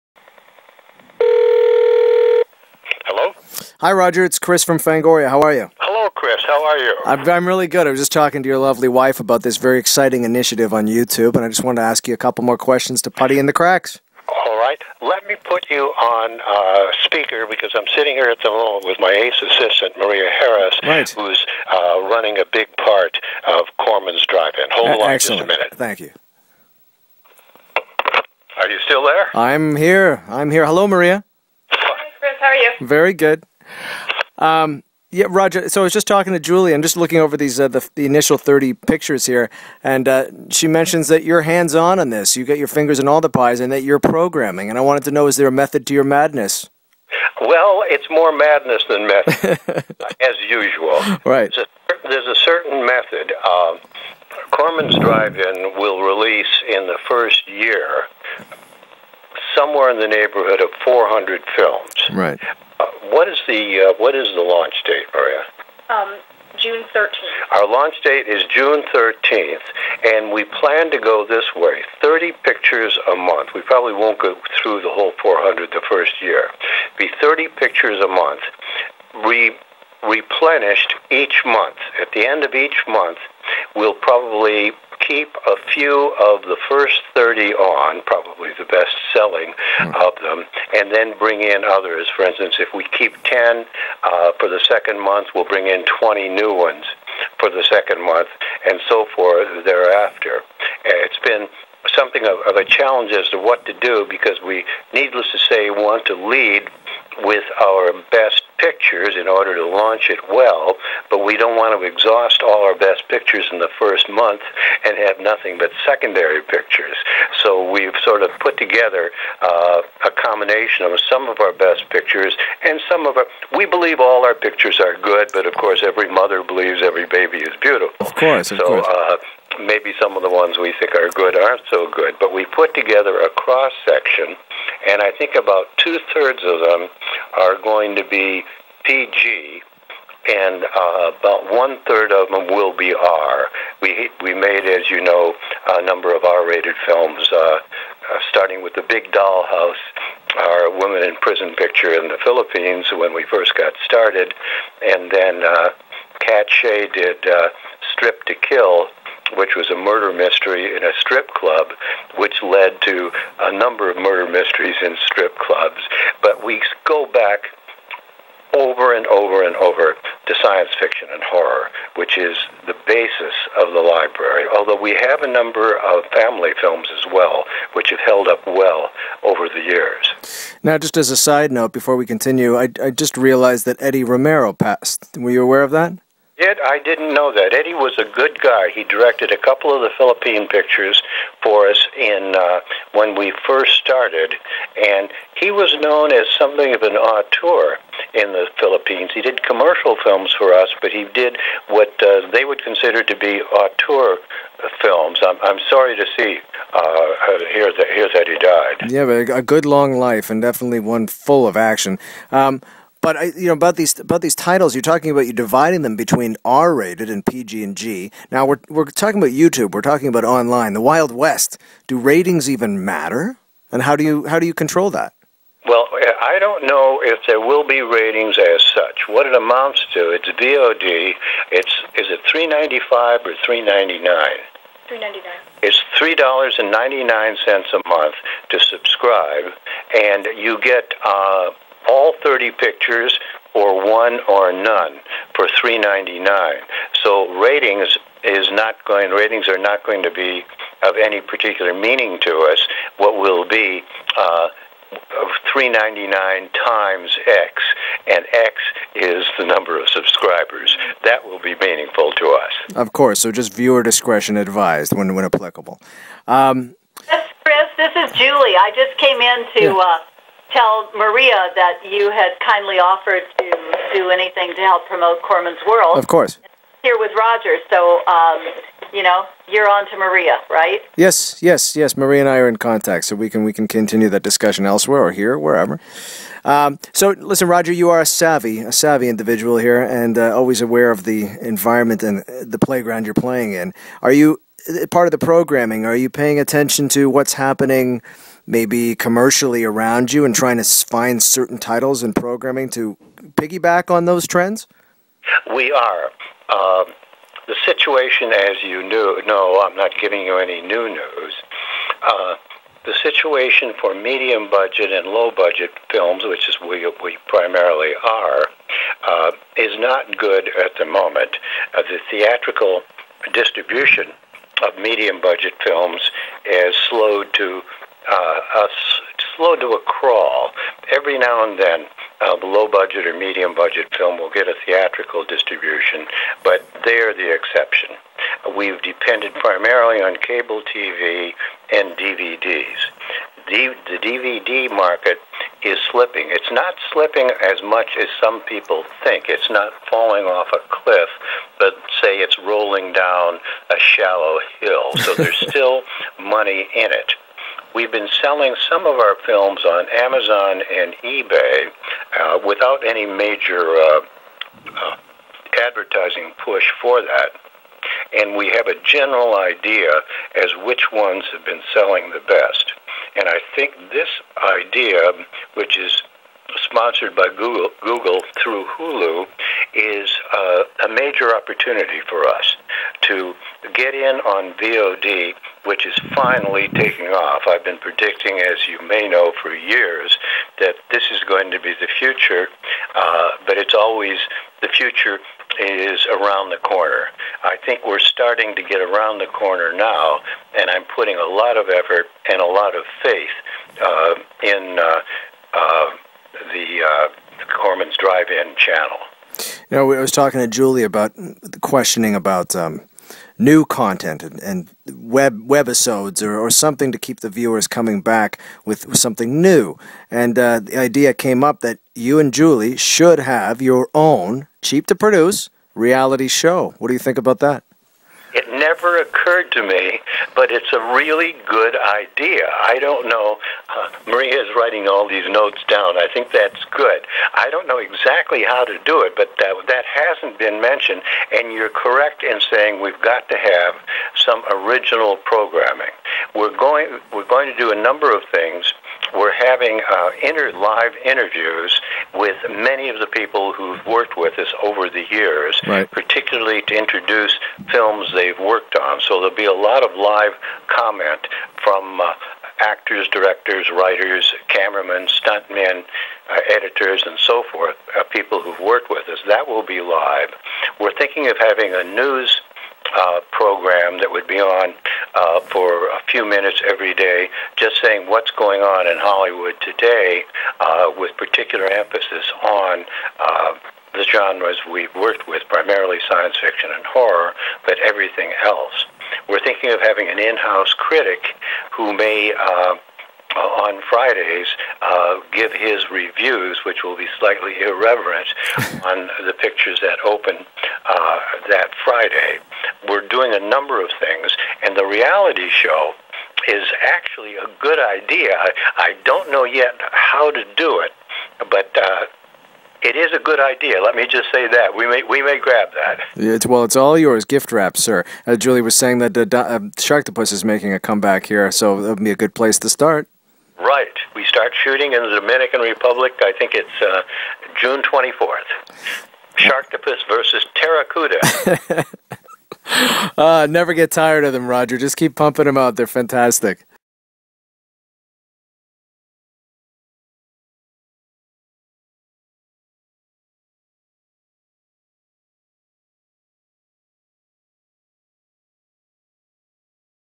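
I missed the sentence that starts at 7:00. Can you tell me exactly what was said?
And uh, the idea came up that you and Julie should have your own cheap to produce reality show.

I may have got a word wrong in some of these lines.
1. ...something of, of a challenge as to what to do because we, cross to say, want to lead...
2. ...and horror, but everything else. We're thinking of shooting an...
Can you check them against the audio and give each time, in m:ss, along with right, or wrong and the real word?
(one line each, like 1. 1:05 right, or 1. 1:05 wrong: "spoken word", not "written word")
1. 1:41 wrong: "needless", not "cross"
2. 8:06 wrong: "having", not "shooting".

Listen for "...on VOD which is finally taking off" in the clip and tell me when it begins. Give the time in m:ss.
6:24.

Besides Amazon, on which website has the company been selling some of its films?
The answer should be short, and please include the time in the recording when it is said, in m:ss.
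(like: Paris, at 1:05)
eBay, at 6:01.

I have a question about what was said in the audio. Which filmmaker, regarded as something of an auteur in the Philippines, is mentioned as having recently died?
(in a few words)
Eddie Romero.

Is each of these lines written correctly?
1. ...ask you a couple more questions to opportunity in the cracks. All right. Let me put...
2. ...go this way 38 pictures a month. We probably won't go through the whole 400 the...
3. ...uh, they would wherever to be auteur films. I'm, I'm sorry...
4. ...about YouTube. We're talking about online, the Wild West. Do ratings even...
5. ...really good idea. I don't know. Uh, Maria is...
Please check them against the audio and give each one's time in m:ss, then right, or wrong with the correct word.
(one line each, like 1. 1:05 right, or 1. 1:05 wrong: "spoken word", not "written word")
1. 0:11 wrong: "putty", not "opportunity"
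2. 1:10 wrong: "30", not "38"
3. 3:22 wrong: "consider", not "wherever"
4. 3:39 right
5. 7:10 right.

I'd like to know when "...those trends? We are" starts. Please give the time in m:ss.
5:04.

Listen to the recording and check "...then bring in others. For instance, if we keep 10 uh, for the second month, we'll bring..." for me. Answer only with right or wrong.
right.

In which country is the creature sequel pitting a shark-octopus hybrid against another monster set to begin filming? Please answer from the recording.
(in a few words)
Dominican Republic.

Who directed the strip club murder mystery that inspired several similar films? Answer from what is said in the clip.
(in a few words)
Katt Shea.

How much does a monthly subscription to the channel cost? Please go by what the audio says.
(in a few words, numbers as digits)
$3.99.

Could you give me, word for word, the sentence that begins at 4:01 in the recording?
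Uh, all 30 pictures or one or none for 3.99.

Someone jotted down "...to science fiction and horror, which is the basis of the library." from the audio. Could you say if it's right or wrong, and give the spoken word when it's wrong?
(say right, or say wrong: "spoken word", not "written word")
right.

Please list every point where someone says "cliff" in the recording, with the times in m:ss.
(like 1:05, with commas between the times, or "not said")
5:50.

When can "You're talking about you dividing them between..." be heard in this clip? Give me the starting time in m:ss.
3:34.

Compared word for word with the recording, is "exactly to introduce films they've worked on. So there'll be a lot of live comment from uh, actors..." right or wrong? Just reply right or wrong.
wrong.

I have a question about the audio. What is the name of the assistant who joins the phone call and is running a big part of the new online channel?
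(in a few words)
Maria Harris.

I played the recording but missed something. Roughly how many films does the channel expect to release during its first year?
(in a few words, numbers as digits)
400.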